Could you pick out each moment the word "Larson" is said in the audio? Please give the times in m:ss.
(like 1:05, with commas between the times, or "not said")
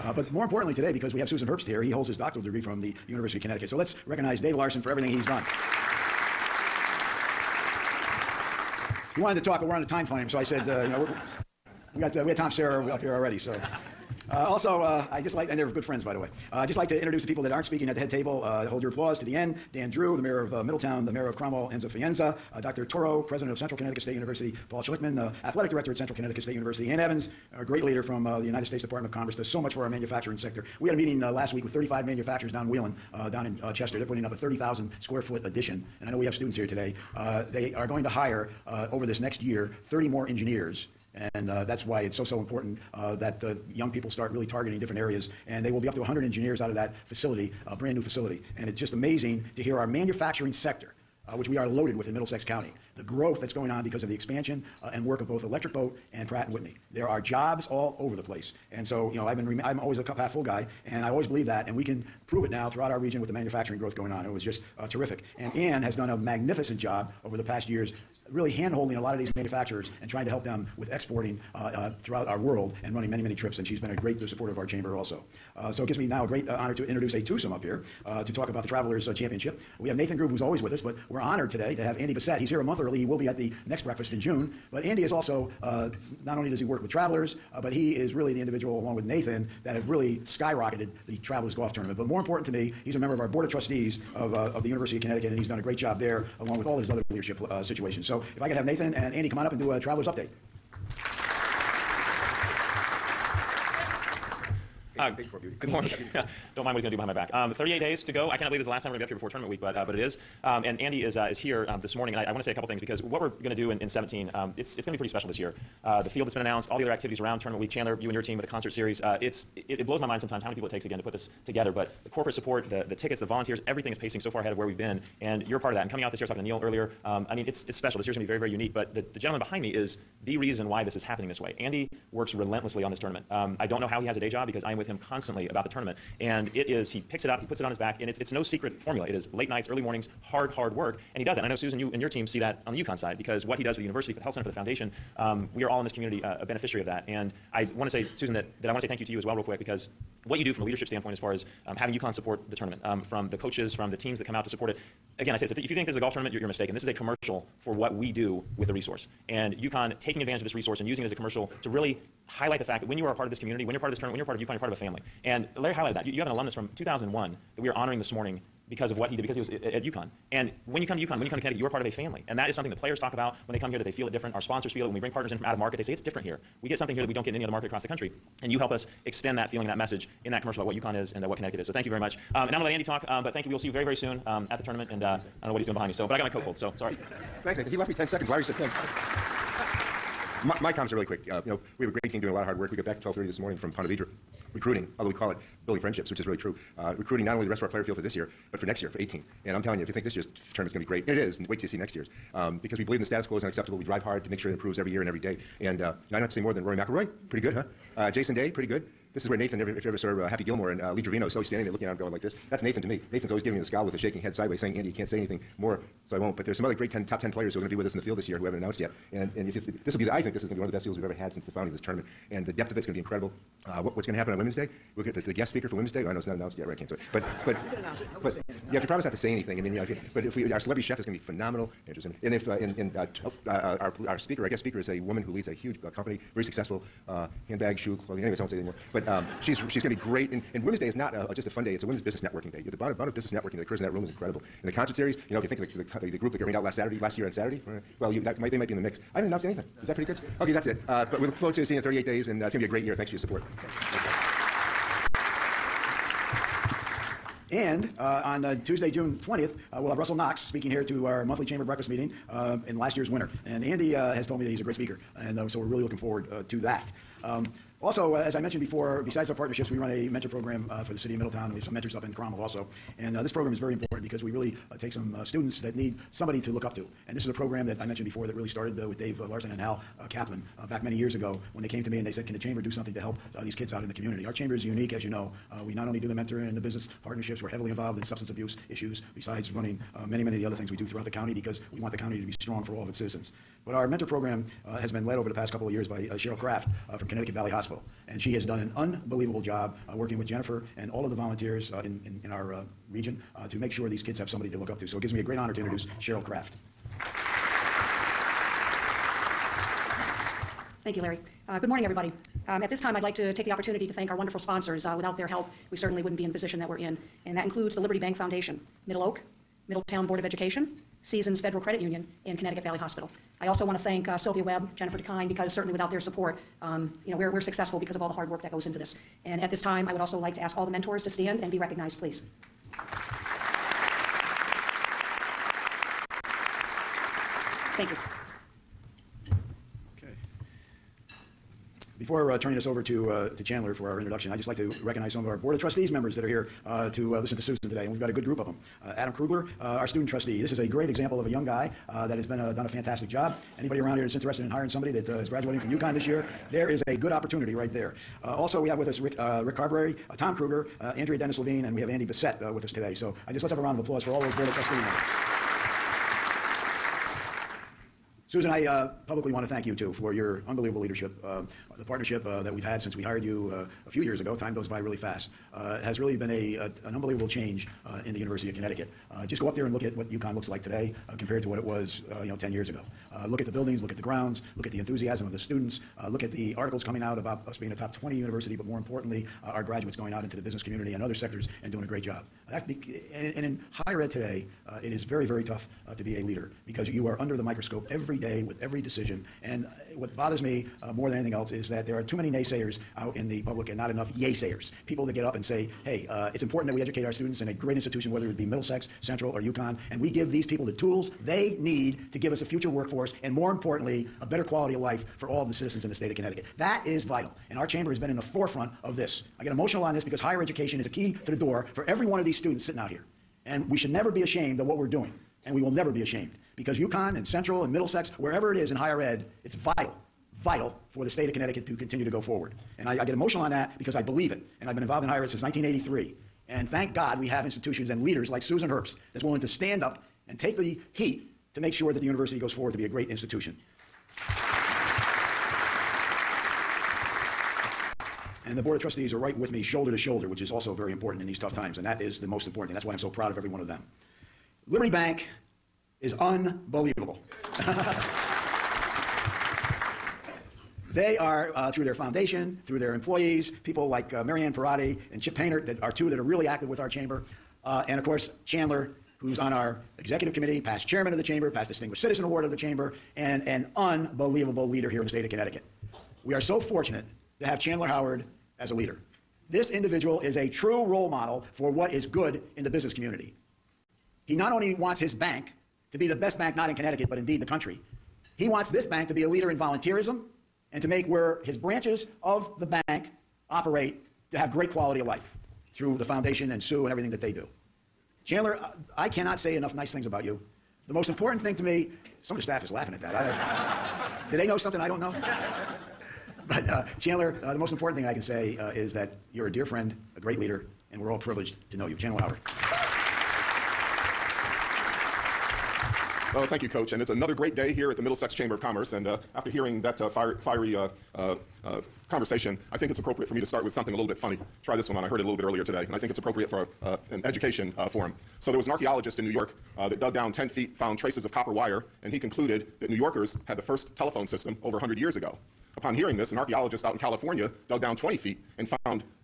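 0:04, 4:39.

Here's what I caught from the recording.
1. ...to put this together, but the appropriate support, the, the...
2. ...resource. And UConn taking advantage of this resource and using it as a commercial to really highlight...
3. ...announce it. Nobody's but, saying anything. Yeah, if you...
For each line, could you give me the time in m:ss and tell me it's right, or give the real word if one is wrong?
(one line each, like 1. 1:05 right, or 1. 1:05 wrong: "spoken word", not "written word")
1. 2:00 wrong: "corporate", not "appropriate"
2. 2:38 right
3. 3:47 right.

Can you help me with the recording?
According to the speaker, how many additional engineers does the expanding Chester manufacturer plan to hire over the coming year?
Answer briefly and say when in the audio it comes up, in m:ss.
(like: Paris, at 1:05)
30, at 0:39.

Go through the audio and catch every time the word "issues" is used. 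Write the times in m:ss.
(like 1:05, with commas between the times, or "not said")
4:48.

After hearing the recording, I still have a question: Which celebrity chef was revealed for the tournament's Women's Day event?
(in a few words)
Andrew Zimmern.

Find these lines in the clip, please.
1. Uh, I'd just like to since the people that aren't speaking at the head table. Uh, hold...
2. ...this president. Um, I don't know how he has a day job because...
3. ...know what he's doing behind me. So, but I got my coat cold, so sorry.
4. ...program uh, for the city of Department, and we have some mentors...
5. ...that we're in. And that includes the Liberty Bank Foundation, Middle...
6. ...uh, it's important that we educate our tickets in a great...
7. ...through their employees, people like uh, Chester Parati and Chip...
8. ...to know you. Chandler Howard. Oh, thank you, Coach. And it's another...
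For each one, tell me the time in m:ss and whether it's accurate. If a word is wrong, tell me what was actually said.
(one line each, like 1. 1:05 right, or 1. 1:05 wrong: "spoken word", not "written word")
1. 0:16 wrong: "introduce", not "since"
2. 2:12 wrong: "tournament", not "president"
3. 3:05 right
4. 4:30 wrong: "Middletown", not "Department"
5. 5:16 right
6. 6:46 wrong: "students", not "tickets"
7. 7:42 wrong: "Marianne", not "Chester"
8. 8:31 right.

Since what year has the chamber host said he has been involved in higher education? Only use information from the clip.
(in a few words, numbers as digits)
1983.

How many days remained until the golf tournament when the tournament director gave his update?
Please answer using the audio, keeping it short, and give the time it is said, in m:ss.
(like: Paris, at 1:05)
38, at 1:47.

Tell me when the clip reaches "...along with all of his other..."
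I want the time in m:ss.
1:36.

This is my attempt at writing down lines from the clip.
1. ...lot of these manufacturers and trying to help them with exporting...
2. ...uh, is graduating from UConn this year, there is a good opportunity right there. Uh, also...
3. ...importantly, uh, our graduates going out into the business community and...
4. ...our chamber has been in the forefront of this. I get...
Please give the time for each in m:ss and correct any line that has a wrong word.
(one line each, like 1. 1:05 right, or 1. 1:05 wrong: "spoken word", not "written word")
1. 1:08 right
2. 5:55 right
3. 6:28 right
4. 6:57 right.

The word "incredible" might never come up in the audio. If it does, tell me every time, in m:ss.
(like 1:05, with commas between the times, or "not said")
3:43, 4:04.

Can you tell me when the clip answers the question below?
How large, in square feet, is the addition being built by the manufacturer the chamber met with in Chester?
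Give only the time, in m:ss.
0:34.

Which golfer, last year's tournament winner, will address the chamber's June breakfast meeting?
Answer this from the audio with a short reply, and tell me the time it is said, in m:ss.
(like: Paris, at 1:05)
Russell Knox, at 4:19.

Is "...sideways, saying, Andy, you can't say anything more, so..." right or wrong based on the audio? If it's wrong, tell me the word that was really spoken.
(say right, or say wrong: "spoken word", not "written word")
right.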